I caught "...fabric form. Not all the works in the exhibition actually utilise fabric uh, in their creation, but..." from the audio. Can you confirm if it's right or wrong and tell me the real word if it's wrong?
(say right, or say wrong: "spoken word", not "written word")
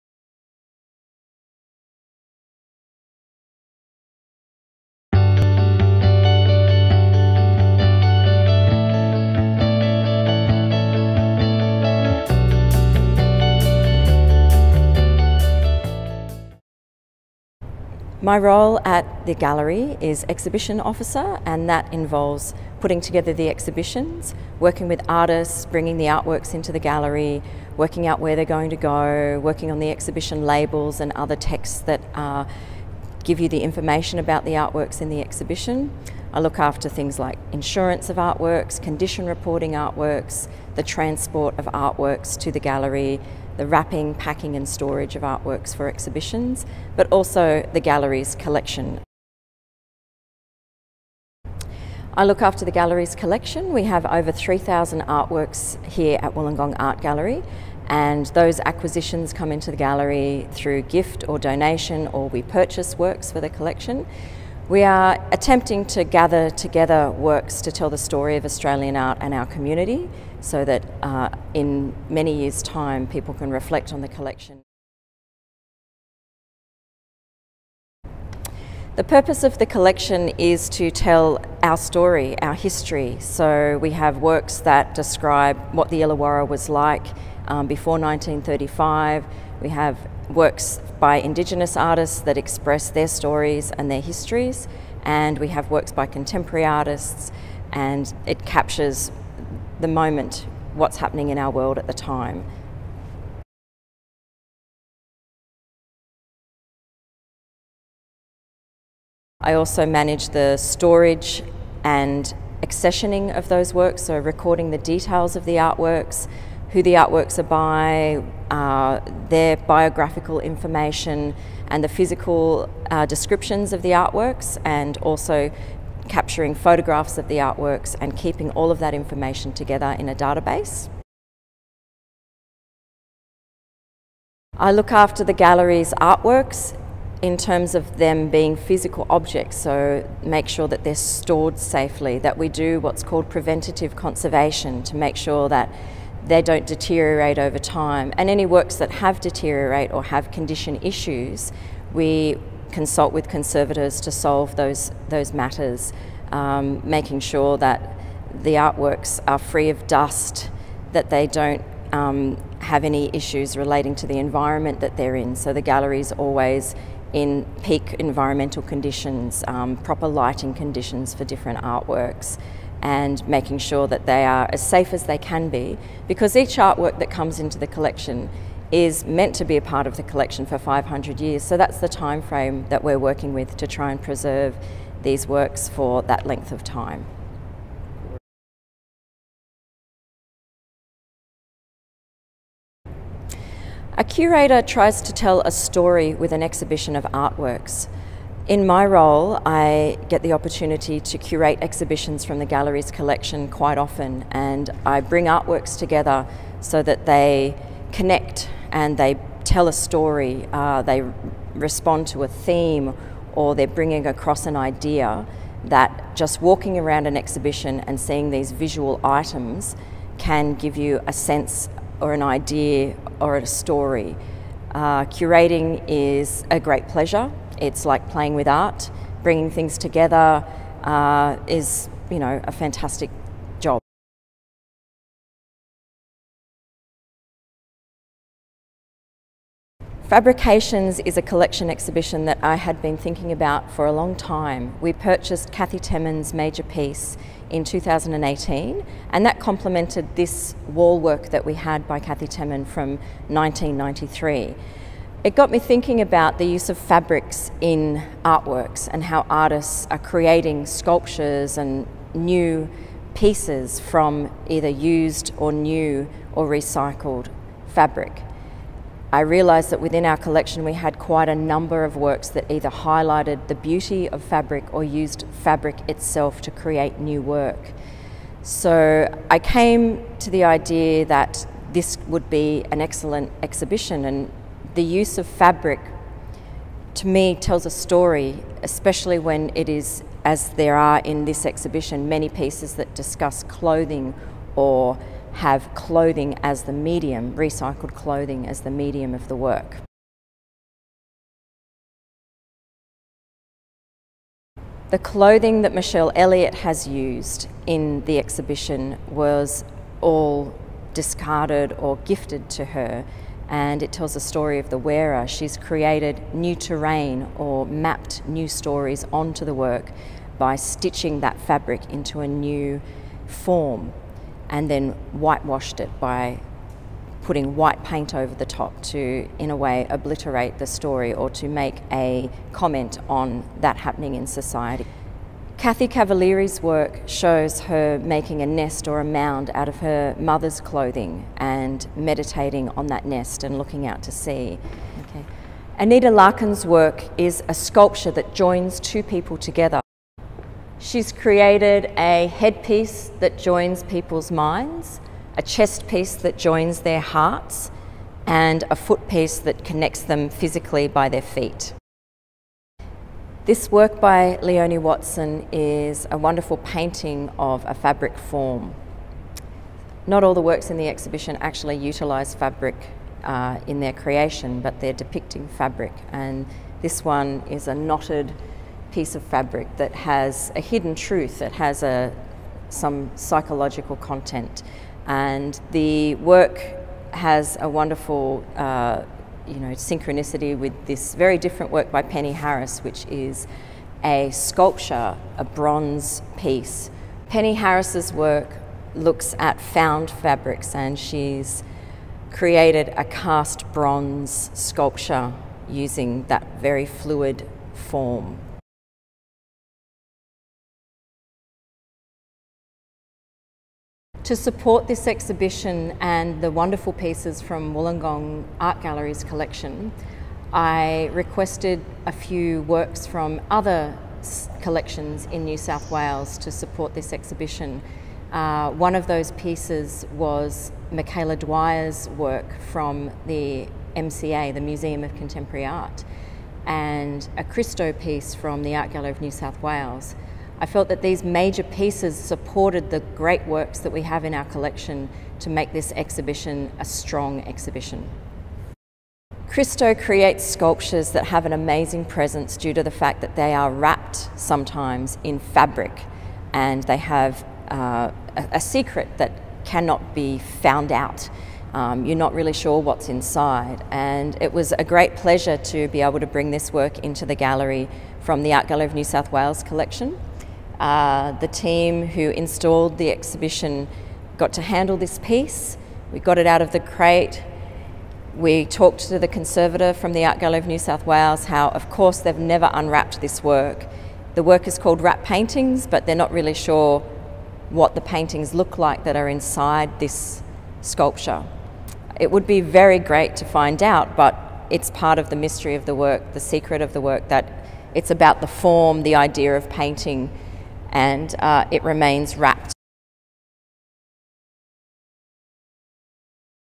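right.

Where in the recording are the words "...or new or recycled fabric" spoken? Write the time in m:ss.
4:25.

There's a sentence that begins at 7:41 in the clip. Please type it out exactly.
Um, you're not really sure what's inside.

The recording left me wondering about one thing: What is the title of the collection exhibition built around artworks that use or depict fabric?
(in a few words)
Fabrications.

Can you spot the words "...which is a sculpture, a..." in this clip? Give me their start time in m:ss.
6:32.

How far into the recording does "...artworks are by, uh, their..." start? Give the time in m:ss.
1:56.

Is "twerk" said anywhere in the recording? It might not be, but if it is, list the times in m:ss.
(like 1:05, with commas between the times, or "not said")
not said.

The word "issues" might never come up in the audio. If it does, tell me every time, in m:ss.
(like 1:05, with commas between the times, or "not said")
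2:30, 2:43.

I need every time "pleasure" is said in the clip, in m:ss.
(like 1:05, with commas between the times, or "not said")
3:46, 7:45.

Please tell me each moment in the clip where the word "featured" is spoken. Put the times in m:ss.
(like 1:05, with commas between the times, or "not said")
not said.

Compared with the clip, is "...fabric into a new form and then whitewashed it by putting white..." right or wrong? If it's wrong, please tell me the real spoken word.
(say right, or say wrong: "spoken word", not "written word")
right.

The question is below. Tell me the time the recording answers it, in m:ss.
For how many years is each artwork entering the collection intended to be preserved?
3:00.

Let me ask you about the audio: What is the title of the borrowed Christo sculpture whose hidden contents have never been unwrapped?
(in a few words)
Wrap Paintings.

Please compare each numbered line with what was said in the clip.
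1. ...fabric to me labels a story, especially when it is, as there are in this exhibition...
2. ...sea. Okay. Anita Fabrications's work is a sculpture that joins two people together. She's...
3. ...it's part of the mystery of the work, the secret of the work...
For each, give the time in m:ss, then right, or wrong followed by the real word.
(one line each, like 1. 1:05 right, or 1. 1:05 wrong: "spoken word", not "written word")
1. 4:45 wrong: "tells", not "labels"
2. 5:44 wrong: "Larkin", not "Fabrications"
3. 8:14 right.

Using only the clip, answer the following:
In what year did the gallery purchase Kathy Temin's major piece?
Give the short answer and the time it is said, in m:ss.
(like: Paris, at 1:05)
2018, at 4:07.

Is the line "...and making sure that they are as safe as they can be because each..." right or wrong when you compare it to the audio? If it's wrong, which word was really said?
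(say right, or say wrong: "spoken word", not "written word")
right.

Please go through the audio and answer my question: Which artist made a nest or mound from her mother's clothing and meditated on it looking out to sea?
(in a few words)
Kathy Cavaliere.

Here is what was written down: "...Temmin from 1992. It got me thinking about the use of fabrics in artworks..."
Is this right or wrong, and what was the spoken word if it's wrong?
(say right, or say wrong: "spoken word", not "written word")
wrong: "1993", not "1992".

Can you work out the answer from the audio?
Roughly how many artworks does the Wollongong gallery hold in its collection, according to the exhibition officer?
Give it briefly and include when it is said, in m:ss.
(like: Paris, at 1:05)
over 3,000, at 0:54.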